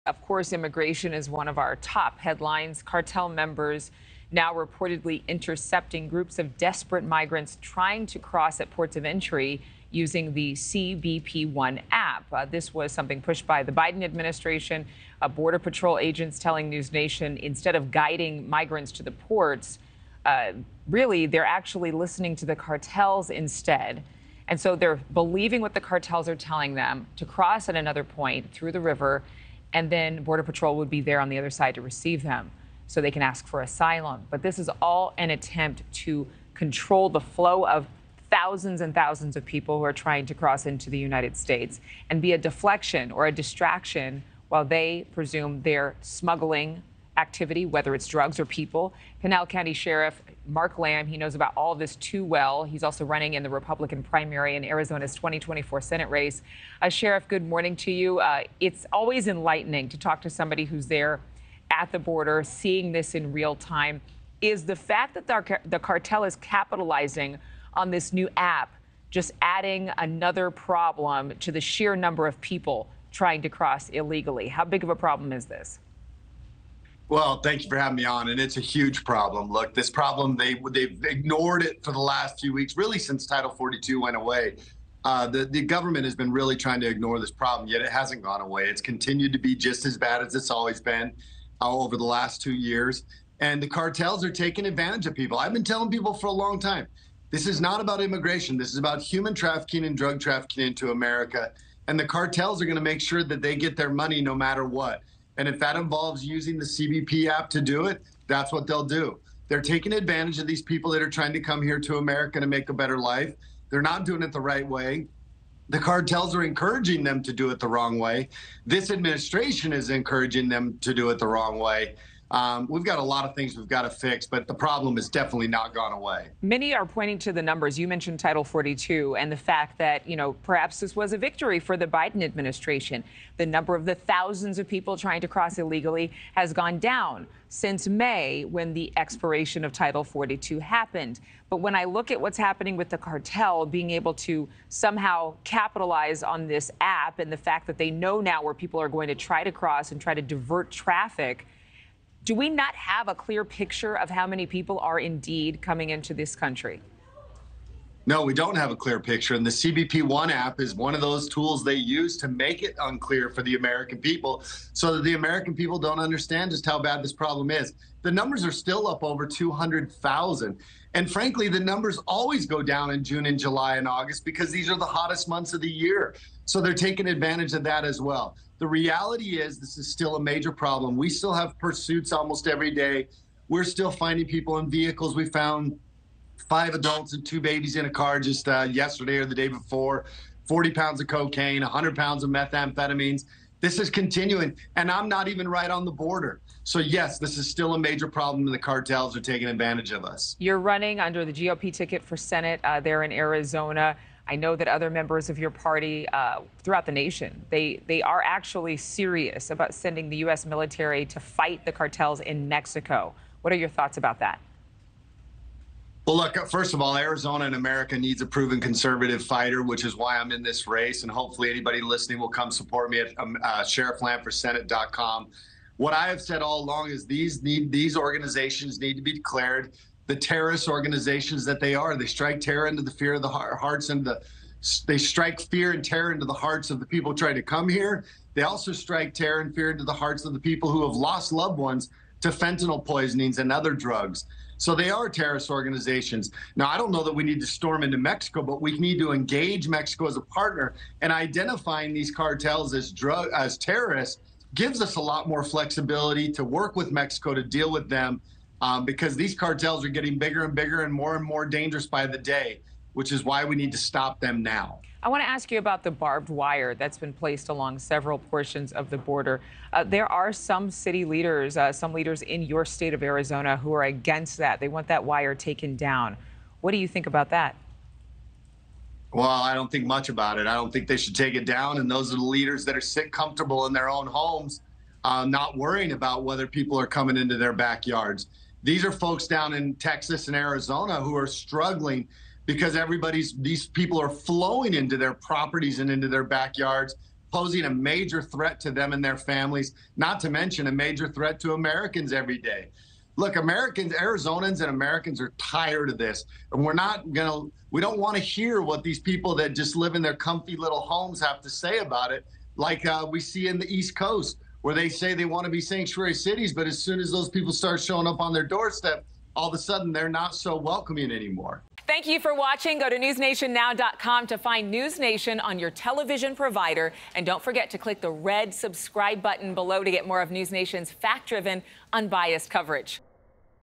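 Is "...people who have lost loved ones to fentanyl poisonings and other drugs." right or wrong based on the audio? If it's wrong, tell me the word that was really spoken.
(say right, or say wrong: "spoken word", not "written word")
right.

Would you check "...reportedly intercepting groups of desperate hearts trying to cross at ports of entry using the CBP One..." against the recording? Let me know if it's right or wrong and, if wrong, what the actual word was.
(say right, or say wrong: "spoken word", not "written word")
wrong: "migrants", not "hearts".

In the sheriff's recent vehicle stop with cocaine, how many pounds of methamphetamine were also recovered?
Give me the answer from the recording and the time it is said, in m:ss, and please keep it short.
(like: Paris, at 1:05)
100, at 3:11.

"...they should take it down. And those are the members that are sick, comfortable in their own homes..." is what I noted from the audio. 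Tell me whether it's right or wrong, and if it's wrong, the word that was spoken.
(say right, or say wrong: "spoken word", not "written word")
wrong: "leaders", not "members".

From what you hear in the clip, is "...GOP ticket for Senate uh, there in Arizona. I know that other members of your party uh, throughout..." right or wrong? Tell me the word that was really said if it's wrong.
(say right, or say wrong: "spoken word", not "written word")
right.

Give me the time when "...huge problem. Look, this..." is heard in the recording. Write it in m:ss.
1:18.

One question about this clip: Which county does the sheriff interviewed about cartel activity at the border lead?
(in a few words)
Pinal County.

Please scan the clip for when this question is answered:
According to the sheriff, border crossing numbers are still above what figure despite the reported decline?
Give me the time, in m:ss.
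2:49.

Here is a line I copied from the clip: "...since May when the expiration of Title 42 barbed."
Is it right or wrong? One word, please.
wrong.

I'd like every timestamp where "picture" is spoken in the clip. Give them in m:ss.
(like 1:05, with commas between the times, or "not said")
2:33, 2:38.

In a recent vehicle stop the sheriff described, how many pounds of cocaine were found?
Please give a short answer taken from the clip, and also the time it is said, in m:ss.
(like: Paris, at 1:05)
40, at 3:10.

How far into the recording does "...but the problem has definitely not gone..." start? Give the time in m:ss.
2:04.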